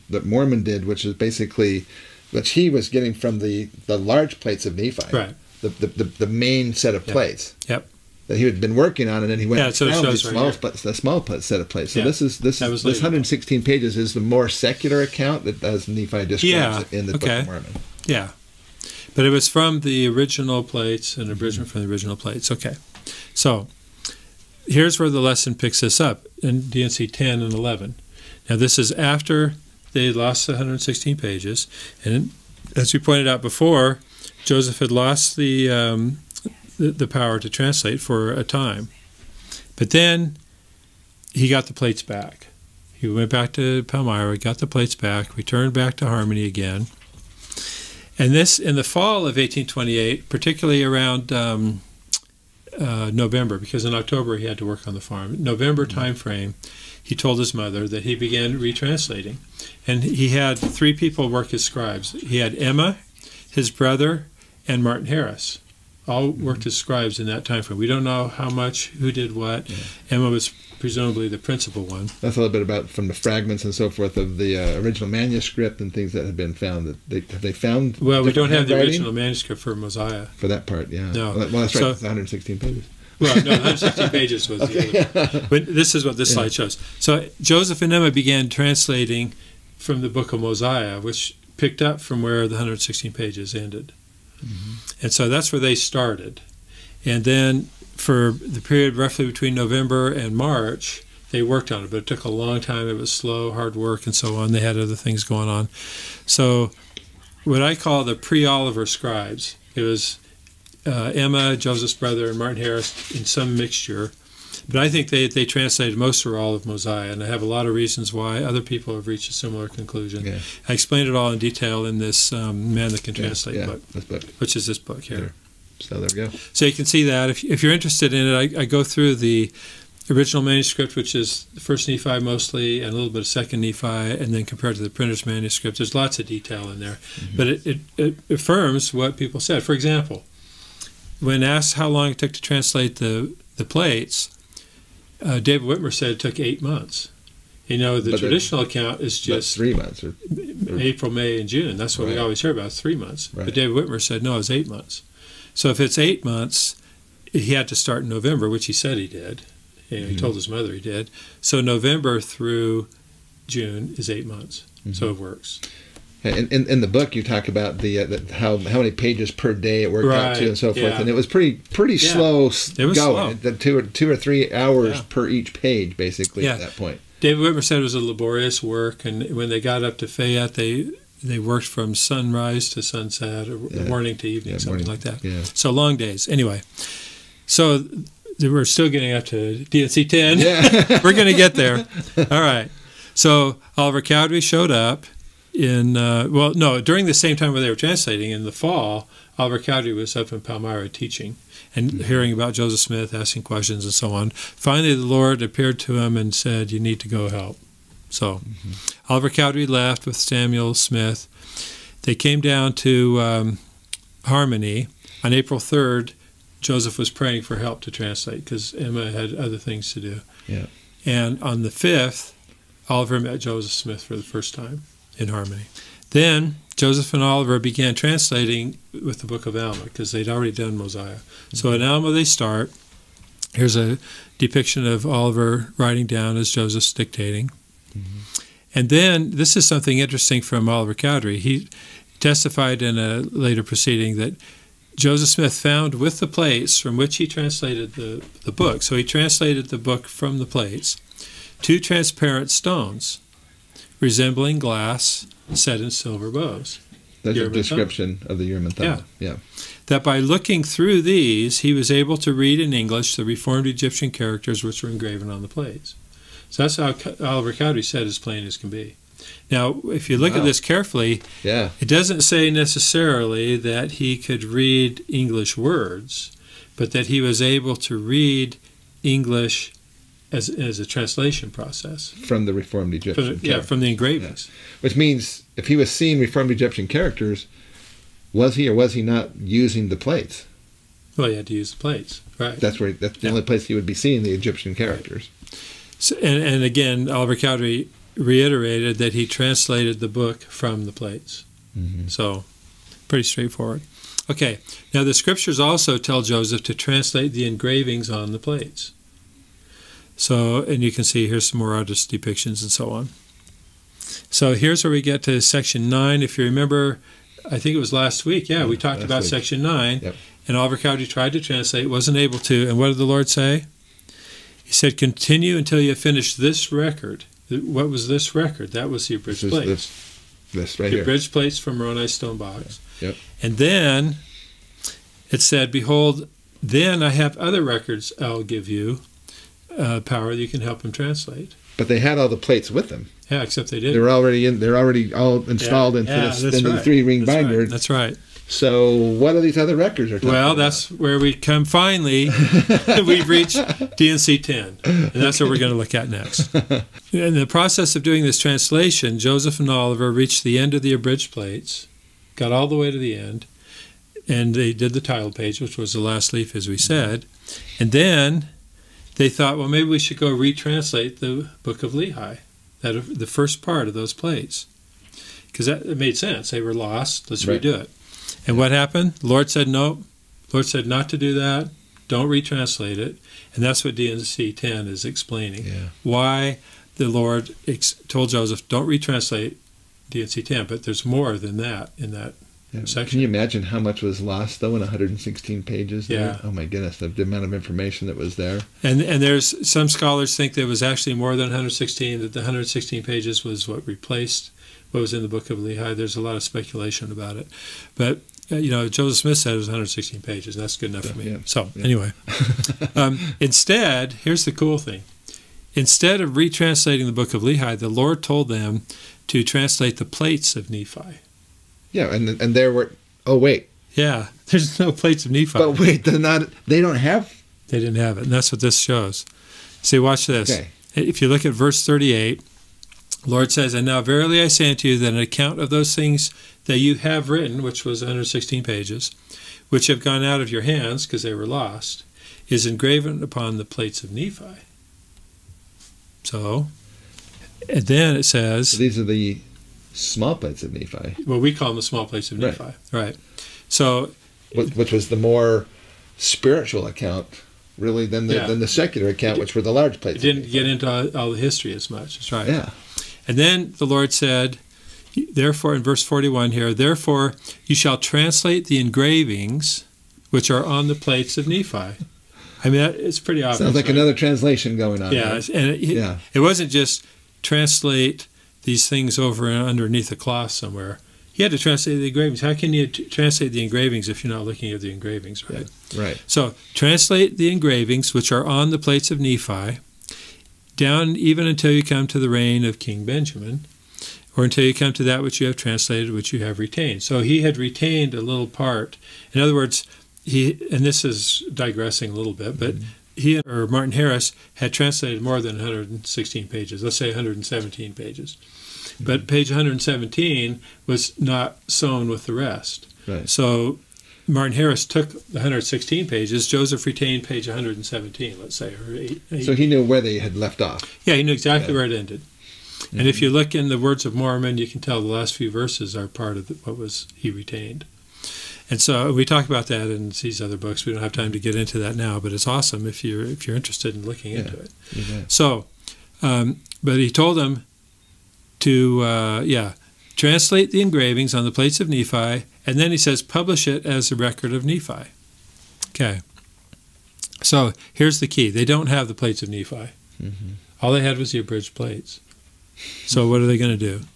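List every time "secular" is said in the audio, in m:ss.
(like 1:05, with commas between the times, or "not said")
0:14, 7:38.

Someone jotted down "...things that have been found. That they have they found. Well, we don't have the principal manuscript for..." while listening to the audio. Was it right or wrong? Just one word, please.
wrong.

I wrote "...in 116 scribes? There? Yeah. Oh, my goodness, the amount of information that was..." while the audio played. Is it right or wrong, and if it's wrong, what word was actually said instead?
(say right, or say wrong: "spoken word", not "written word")
wrong: "pages", not "scribes".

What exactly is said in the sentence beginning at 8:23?
he or Martin Harris had translated more than 116 pages, let's say 117 pages.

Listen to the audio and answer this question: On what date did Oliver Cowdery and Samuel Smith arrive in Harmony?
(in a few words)
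April 3rd.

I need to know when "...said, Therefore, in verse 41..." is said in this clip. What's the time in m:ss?
7:44.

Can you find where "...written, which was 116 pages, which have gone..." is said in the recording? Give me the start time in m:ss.
7:17.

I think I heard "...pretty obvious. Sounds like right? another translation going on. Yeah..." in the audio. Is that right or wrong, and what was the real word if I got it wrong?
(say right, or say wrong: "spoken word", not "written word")
right.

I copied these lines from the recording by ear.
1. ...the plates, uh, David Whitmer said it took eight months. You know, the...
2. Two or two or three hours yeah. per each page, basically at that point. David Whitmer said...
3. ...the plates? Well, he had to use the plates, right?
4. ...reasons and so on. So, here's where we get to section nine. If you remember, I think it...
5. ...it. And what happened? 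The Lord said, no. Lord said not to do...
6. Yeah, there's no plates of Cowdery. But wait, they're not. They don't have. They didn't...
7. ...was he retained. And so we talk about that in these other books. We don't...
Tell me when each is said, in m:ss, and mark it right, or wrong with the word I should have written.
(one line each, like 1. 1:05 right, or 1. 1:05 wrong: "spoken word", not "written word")
1. 2:23 right
2. 2:53 right
3. 4:49 right
4. 5:12 wrong: "depictions", not "reasons"
5. 6:17 right
6. 7:03 wrong: "Nephi", not "Cowdery"
7. 8:46 right.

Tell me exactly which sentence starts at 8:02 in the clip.
How can you translate the engravings if you're not looking at the engravings, right?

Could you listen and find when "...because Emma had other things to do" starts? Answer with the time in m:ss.
3:38.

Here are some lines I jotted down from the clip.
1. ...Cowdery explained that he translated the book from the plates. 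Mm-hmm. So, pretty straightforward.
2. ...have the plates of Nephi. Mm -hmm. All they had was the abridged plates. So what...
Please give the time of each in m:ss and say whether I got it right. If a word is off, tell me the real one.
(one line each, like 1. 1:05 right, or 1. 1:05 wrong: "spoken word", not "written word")
1. 4:57 wrong: "reiterated", not "explained"
2. 9:08 right.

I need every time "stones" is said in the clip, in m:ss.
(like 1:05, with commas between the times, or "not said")
4:12, 5:32.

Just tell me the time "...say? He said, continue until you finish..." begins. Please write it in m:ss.
5:23.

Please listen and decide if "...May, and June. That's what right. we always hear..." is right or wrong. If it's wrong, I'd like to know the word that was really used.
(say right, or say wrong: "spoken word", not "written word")
right.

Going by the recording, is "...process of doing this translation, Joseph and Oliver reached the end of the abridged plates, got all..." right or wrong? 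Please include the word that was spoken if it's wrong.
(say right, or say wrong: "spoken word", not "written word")
right.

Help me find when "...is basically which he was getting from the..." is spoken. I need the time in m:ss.
0:01.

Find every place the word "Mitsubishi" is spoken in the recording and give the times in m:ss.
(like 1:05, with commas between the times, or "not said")
not said.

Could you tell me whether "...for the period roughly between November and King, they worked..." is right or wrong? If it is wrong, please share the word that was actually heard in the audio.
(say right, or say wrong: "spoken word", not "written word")
wrong: "March", not "King".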